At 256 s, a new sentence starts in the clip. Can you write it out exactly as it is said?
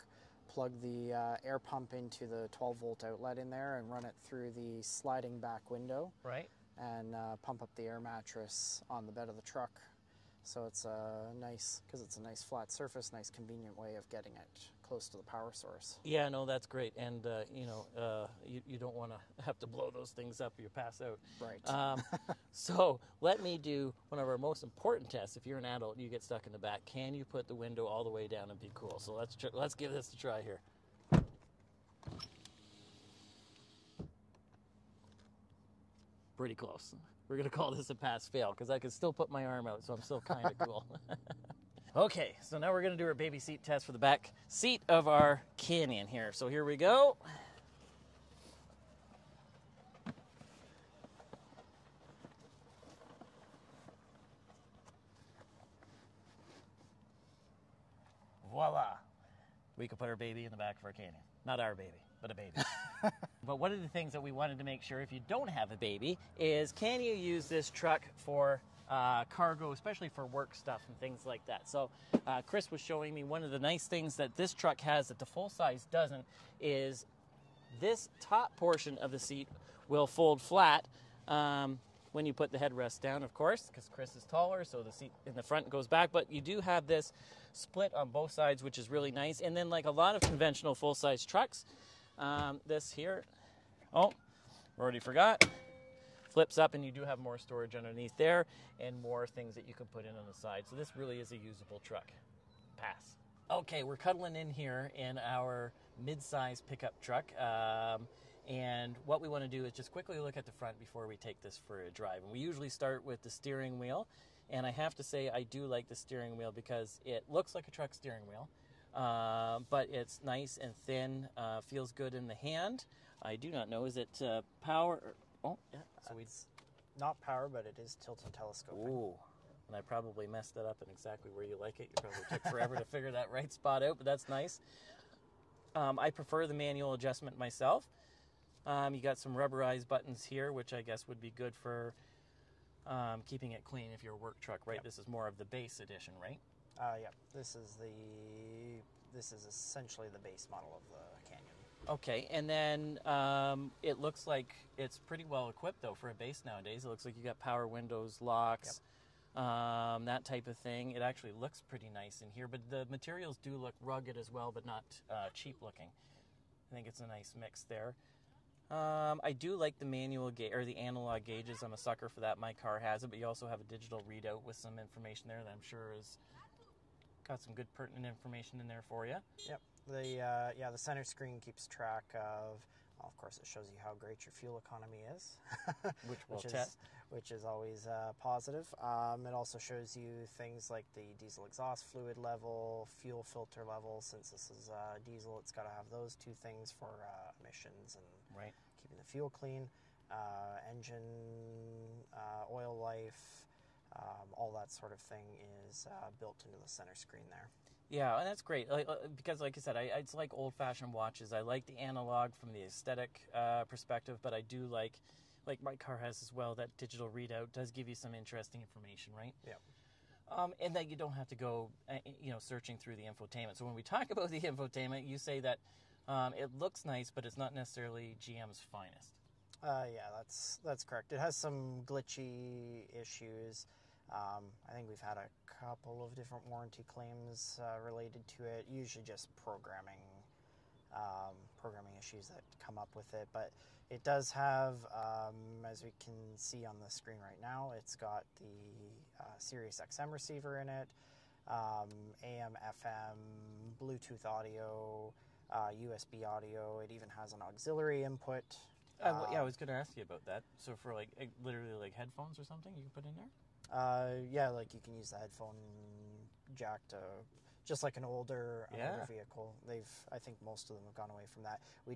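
It even has an auxiliary input.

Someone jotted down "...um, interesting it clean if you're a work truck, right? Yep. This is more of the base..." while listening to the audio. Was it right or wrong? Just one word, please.
wrong.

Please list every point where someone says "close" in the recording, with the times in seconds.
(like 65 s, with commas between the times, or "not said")
14 s, 36 s.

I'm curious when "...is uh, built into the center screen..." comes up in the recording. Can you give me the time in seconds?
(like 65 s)
205 s.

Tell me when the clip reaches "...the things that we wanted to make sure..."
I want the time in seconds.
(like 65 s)
63 s.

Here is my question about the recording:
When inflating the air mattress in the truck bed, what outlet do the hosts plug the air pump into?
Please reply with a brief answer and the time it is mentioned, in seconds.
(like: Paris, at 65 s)
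12 volt outlet, at 2 s.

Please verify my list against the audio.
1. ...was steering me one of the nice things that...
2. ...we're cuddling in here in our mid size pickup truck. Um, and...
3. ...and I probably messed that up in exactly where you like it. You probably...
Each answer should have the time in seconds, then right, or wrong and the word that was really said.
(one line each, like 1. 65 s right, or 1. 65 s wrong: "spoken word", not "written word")
1. 72 s wrong: "showing", not "steering"
2. 103 s right
3. 129 s right.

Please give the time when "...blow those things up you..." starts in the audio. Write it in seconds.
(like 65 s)
19 s.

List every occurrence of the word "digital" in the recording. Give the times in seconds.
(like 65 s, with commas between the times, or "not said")
173 s, 216 s.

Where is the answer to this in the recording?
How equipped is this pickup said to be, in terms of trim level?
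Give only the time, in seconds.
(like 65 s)
150 s.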